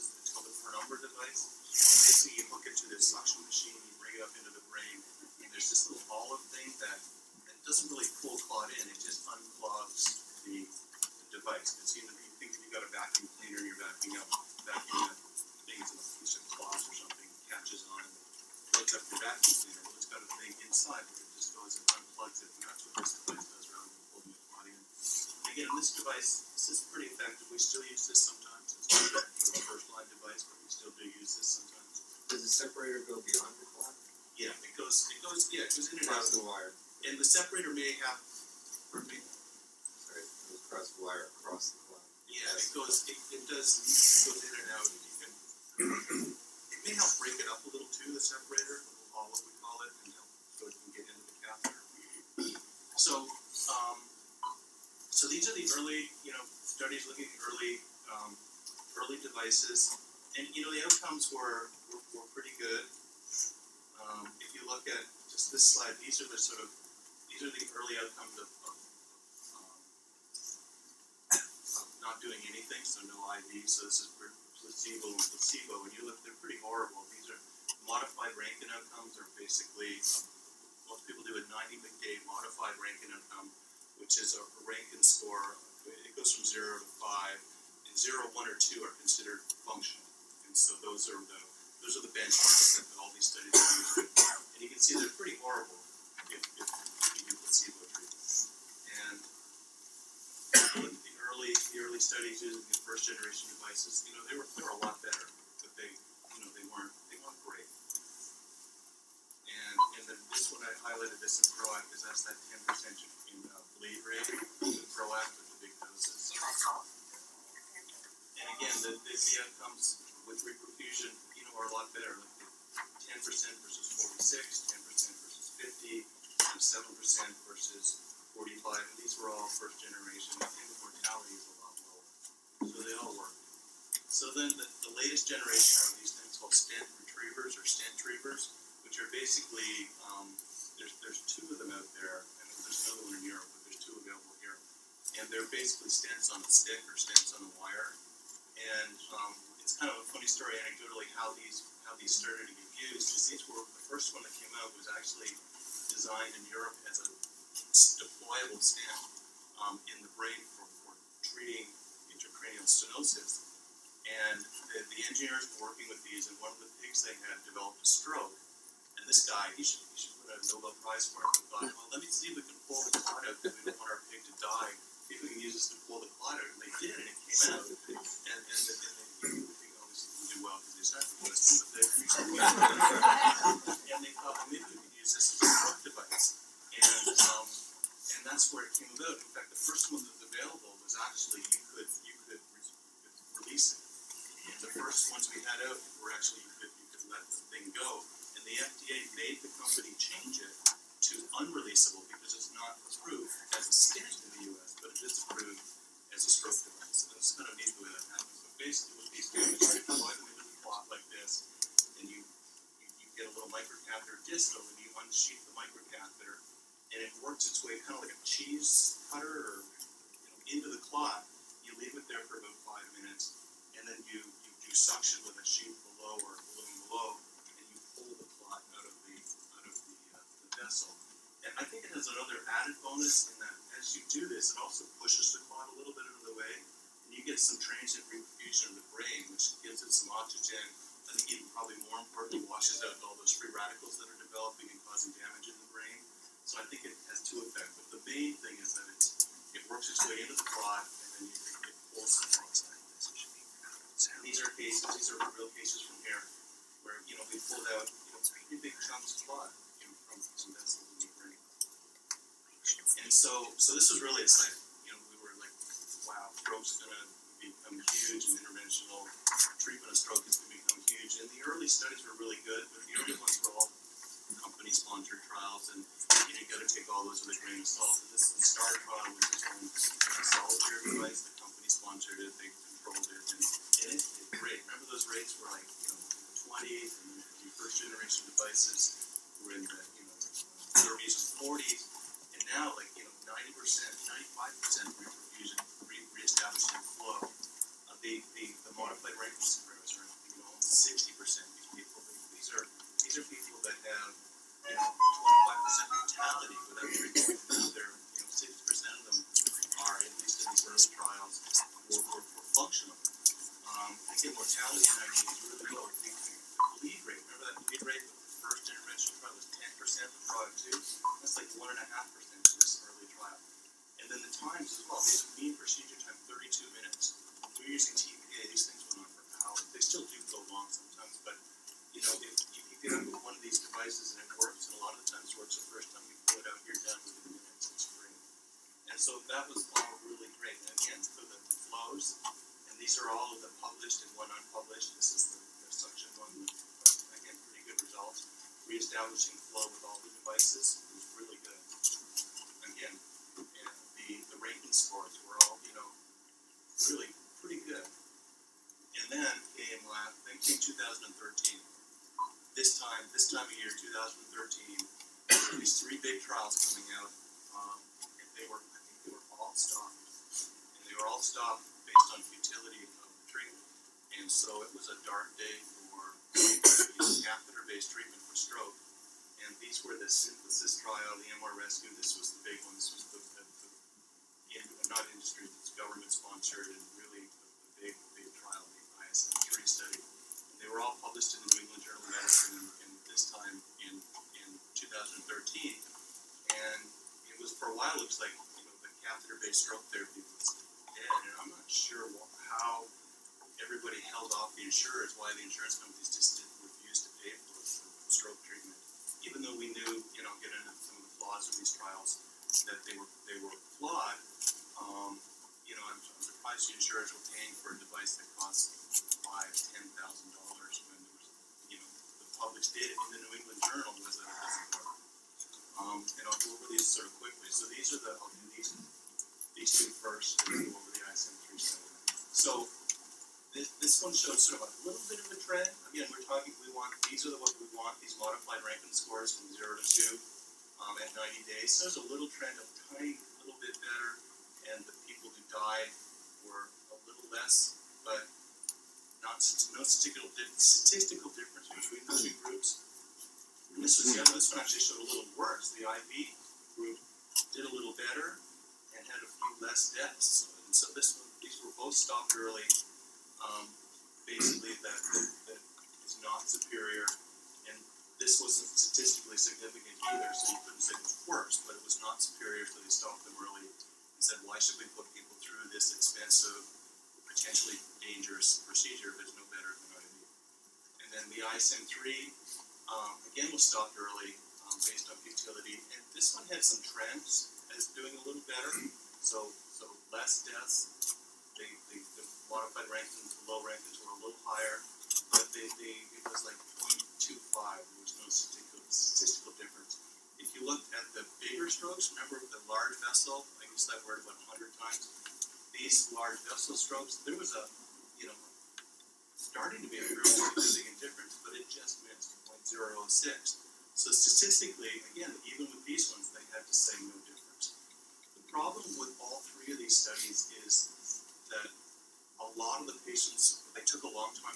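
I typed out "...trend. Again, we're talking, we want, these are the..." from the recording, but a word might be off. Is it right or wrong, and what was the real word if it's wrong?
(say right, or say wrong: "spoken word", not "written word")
right.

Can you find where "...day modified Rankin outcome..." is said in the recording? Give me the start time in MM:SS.
01:21.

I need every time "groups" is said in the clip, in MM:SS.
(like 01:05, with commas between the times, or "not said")
07:32, 07:36.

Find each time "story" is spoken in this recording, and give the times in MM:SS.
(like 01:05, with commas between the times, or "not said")
02:30.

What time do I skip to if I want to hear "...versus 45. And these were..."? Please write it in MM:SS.
02:07.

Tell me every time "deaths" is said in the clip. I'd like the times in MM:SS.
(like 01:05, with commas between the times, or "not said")
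07:39, 08:10.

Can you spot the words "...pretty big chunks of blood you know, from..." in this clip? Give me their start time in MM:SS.
04:18.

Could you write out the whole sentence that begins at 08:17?
There was no statistical, statistical difference.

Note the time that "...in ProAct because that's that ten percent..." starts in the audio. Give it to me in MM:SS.
01:51.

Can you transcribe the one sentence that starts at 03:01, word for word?
But they, and they thought, well, maybe we could use this as a stroke device.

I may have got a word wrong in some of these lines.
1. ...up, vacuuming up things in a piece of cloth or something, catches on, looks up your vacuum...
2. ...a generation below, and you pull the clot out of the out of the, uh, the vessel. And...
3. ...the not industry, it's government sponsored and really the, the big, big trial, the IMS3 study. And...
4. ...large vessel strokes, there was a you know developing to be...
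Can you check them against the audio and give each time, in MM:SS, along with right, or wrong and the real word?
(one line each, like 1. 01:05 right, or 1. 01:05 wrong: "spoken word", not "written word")
1. 00:14 right
2. 03:46 wrong: "balloon", not "generation"
3. 06:24 right
4. 08:26 wrong: "starting", not "developing".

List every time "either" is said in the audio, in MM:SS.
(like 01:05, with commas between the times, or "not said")
07:50.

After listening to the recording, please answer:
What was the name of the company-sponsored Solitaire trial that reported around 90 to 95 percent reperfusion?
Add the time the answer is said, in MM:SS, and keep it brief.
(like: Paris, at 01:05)
StarCon, at 04:38.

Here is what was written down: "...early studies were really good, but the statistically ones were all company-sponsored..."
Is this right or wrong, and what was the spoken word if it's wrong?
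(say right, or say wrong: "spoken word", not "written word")
wrong: "early", not "statistically".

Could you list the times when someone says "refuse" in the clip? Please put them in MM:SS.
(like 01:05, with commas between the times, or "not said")
06:46.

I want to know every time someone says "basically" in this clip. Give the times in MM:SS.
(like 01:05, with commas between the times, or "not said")
00:01, 01:19, 02:19, 02:25, 03:28, 07:44.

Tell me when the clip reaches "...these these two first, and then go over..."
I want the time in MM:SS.
07:08.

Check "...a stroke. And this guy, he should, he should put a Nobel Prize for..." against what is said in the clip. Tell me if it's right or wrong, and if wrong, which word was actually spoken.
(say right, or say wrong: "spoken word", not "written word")
right.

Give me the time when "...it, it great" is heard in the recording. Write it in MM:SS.
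04:43.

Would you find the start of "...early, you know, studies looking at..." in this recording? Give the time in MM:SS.
00:55.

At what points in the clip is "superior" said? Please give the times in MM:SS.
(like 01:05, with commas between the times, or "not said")
07:46, 07:52.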